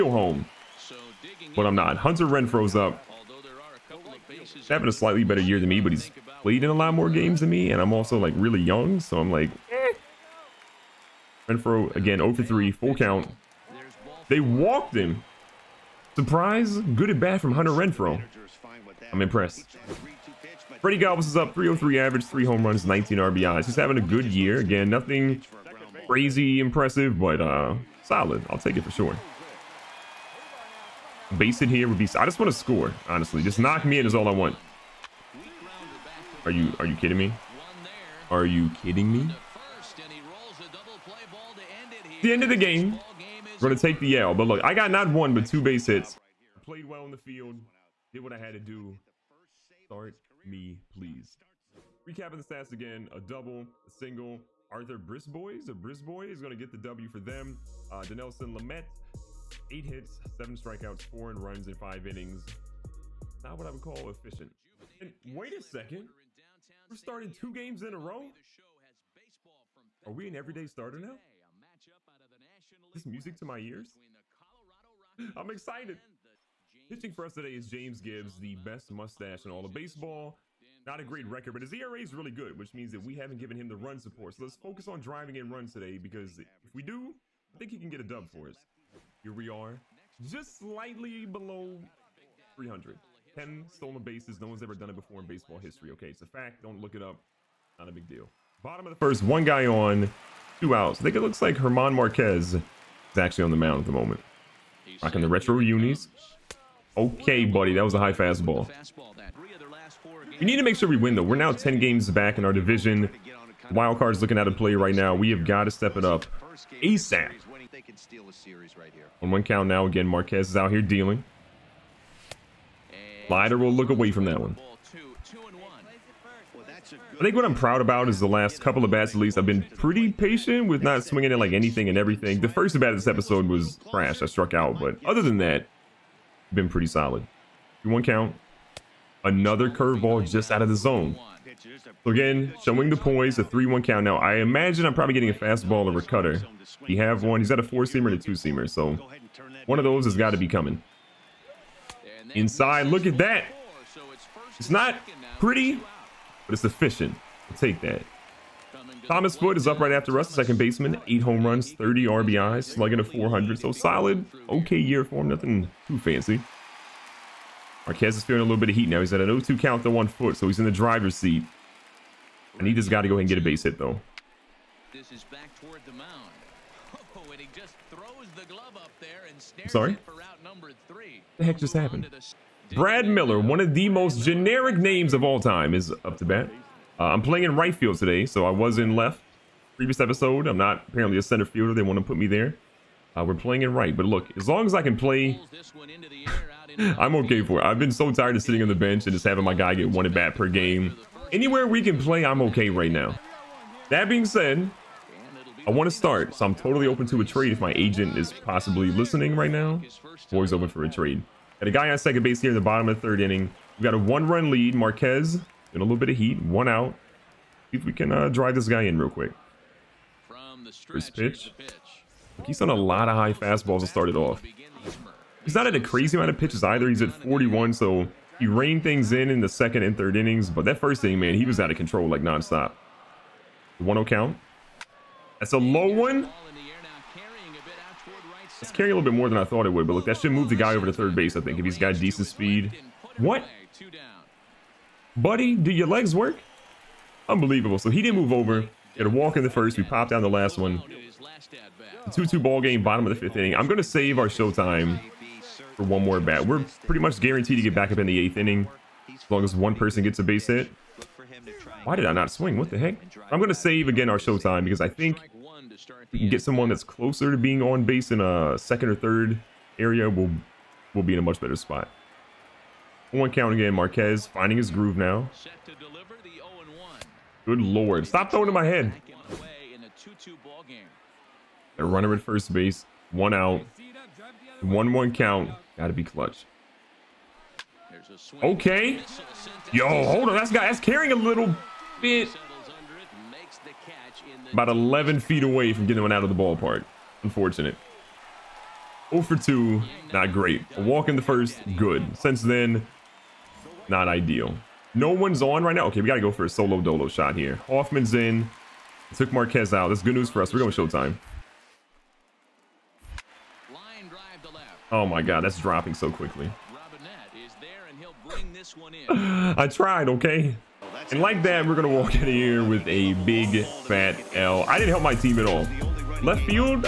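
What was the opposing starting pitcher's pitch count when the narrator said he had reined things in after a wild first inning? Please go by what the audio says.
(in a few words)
41.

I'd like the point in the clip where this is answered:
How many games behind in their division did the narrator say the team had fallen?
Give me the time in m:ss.
1:51.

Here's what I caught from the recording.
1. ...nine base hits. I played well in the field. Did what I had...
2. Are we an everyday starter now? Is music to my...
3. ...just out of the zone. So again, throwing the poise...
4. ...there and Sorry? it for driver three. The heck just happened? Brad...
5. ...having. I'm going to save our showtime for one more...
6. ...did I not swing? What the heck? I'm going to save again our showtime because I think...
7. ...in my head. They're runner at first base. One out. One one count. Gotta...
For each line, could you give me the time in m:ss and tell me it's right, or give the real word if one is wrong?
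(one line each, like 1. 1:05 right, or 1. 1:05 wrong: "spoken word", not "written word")
1. 0:45 wrong: "two", not "nine"
2. 1:10 right
3. 2:20 wrong: "showing", not "throwing"
4. 2:58 wrong: "number", not "driver"
5. 4:13 wrong: "inning", not "having"
6. 4:21 right
7. 4:38 right.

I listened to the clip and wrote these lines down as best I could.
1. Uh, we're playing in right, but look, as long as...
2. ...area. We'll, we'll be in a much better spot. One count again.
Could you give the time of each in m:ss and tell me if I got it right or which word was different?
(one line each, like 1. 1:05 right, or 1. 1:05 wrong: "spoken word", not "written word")
1. 3:13 right
2. 4:29 right.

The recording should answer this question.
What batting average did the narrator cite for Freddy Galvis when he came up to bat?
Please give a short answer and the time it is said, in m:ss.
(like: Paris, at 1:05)
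.303, at 0:21.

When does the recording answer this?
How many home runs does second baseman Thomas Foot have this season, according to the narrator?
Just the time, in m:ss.
2:41.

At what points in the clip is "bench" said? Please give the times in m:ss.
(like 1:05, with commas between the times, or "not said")
3:18.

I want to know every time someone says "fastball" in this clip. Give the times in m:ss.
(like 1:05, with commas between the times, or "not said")
1:48, 2:25, 3:43.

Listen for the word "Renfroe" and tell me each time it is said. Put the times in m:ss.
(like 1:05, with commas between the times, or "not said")
0:02, 0:11, 0:17.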